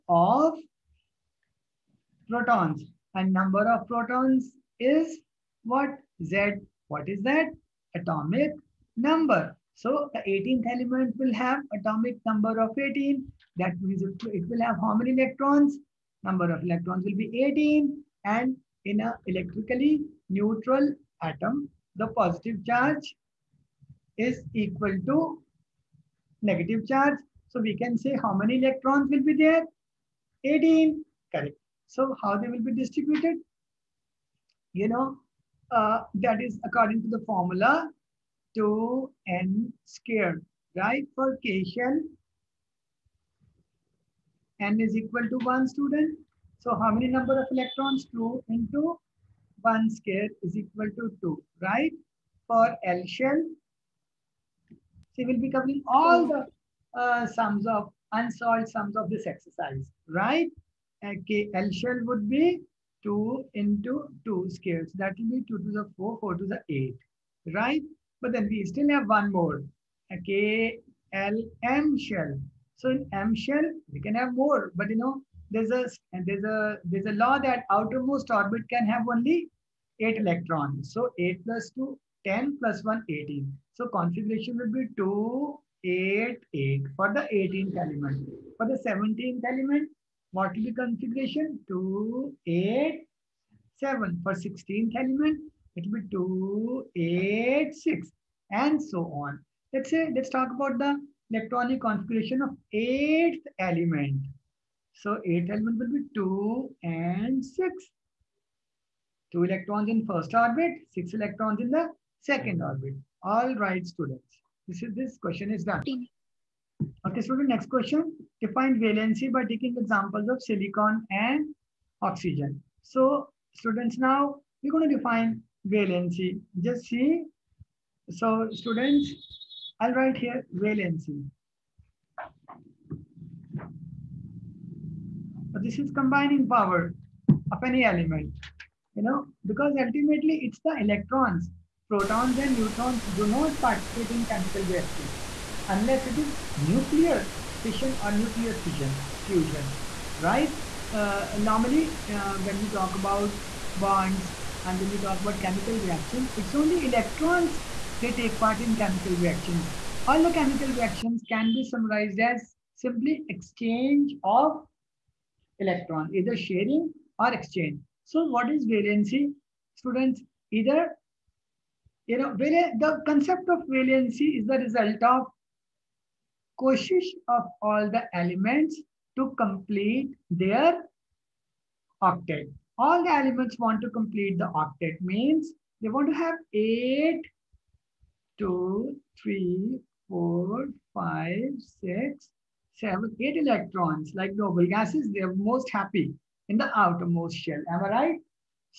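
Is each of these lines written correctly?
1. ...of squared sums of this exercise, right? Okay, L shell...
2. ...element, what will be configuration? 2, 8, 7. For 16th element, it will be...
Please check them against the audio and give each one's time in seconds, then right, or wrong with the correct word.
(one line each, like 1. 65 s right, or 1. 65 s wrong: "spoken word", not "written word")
1. 57 s wrong: "unsolved", not "squared"
2. 89 s right.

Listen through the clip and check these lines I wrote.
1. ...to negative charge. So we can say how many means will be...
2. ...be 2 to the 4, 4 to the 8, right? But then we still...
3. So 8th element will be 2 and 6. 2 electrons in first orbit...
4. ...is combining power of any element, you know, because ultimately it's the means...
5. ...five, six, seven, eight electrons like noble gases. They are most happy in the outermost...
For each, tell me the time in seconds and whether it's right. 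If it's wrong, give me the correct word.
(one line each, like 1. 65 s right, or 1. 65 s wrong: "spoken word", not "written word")
1. 25 s wrong: "electrons", not "means"
2. 65 s right
3. 104 s right
4. 135 s wrong: "electrons", not "means"
5. 190 s right.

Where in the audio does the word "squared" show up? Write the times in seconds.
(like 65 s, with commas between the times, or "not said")
39 s, 49 s.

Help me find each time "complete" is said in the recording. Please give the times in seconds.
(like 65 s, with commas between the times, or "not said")
179 s, 183 s.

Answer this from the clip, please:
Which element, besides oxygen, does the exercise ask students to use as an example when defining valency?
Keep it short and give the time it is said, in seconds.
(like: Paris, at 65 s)
silicon, at 120 s.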